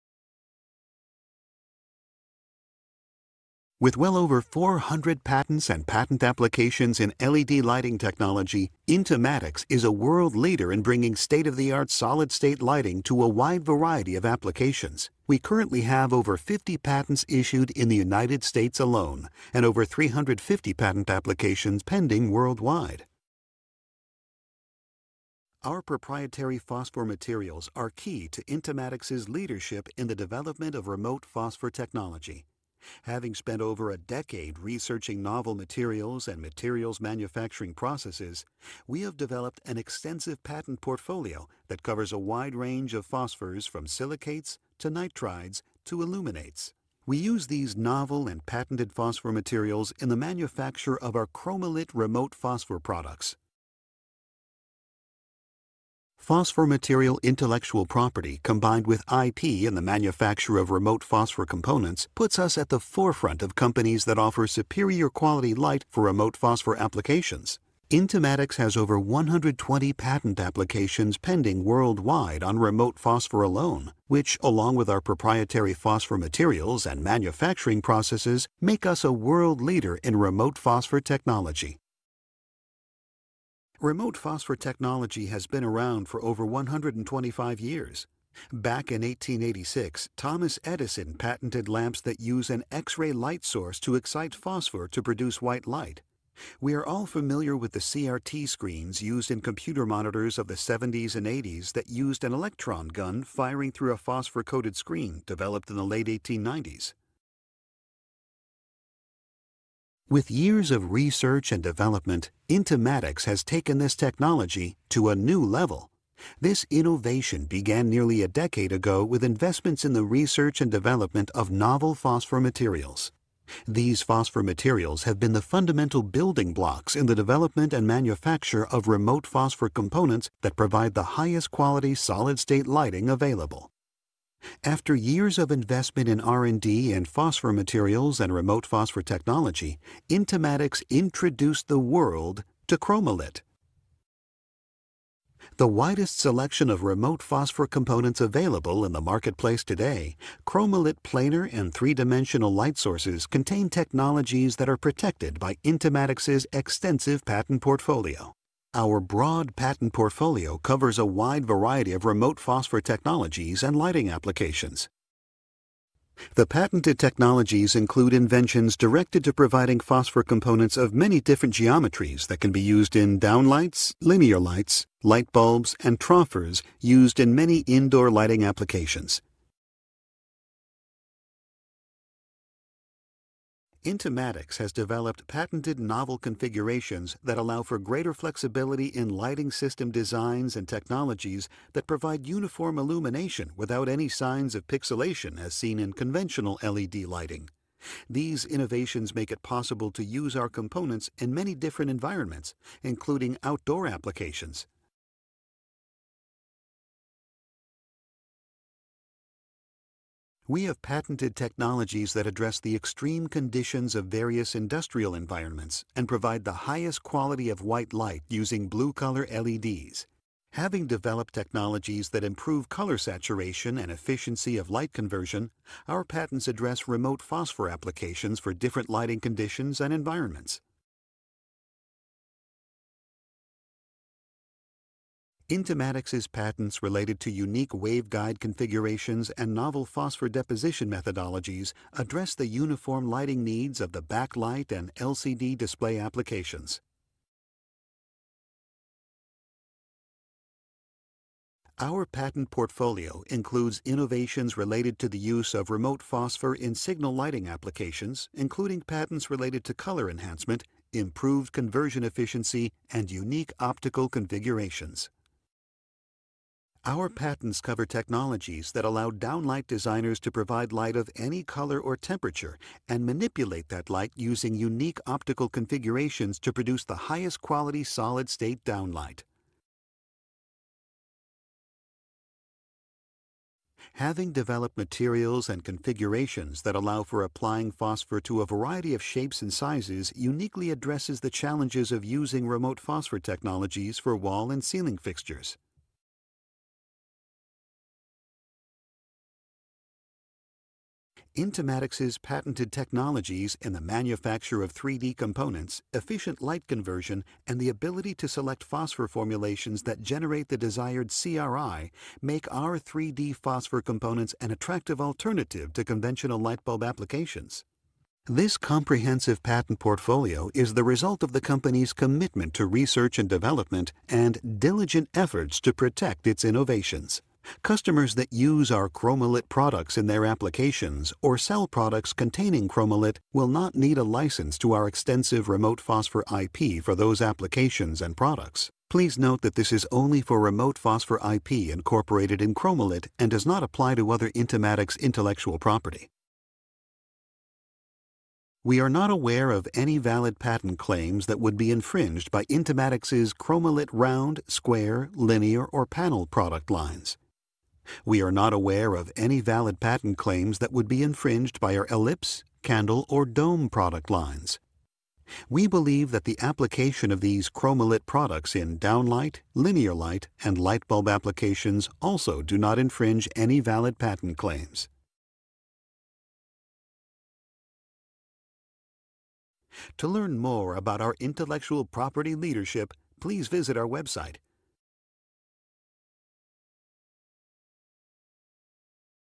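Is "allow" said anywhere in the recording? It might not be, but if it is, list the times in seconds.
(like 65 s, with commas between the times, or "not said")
187 s, 268 s, 286 s.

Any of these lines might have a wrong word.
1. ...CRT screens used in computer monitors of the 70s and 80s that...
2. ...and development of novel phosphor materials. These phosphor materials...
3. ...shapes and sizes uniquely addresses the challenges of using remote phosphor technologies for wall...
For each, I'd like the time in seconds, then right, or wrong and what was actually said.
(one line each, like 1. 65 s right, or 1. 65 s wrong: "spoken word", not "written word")
1. 97 s right
2. 120 s right
3. 289 s right.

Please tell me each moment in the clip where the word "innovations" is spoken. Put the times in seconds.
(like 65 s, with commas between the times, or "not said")
116 s, 198 s, 253 s, 326 s.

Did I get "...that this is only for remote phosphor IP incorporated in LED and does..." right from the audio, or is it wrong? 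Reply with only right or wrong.
wrong.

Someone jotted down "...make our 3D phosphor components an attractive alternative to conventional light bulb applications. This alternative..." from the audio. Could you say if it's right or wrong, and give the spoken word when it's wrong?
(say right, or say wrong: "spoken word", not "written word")
wrong: "comprehensive", not "alternative".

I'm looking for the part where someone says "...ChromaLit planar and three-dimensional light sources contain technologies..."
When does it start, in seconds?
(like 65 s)
150 s.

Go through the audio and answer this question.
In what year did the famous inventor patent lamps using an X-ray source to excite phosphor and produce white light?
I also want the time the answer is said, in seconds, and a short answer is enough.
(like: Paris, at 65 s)
1886, at 89 s.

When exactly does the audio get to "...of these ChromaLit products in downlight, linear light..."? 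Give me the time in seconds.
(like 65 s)
367 s.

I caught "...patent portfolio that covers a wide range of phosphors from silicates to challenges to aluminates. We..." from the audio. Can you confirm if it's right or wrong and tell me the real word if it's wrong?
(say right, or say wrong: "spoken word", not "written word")
wrong: "nitrides", not "challenges".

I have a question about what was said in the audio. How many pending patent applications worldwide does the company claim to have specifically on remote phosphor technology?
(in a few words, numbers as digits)
over 120.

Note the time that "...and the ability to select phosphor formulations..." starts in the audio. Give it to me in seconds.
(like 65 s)
307 s.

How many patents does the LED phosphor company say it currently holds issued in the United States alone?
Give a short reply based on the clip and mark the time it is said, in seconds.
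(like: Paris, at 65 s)
over 50, at 16 s.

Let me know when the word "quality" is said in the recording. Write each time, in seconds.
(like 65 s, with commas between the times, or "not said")
65 s, 131 s, 217 s, 277 s.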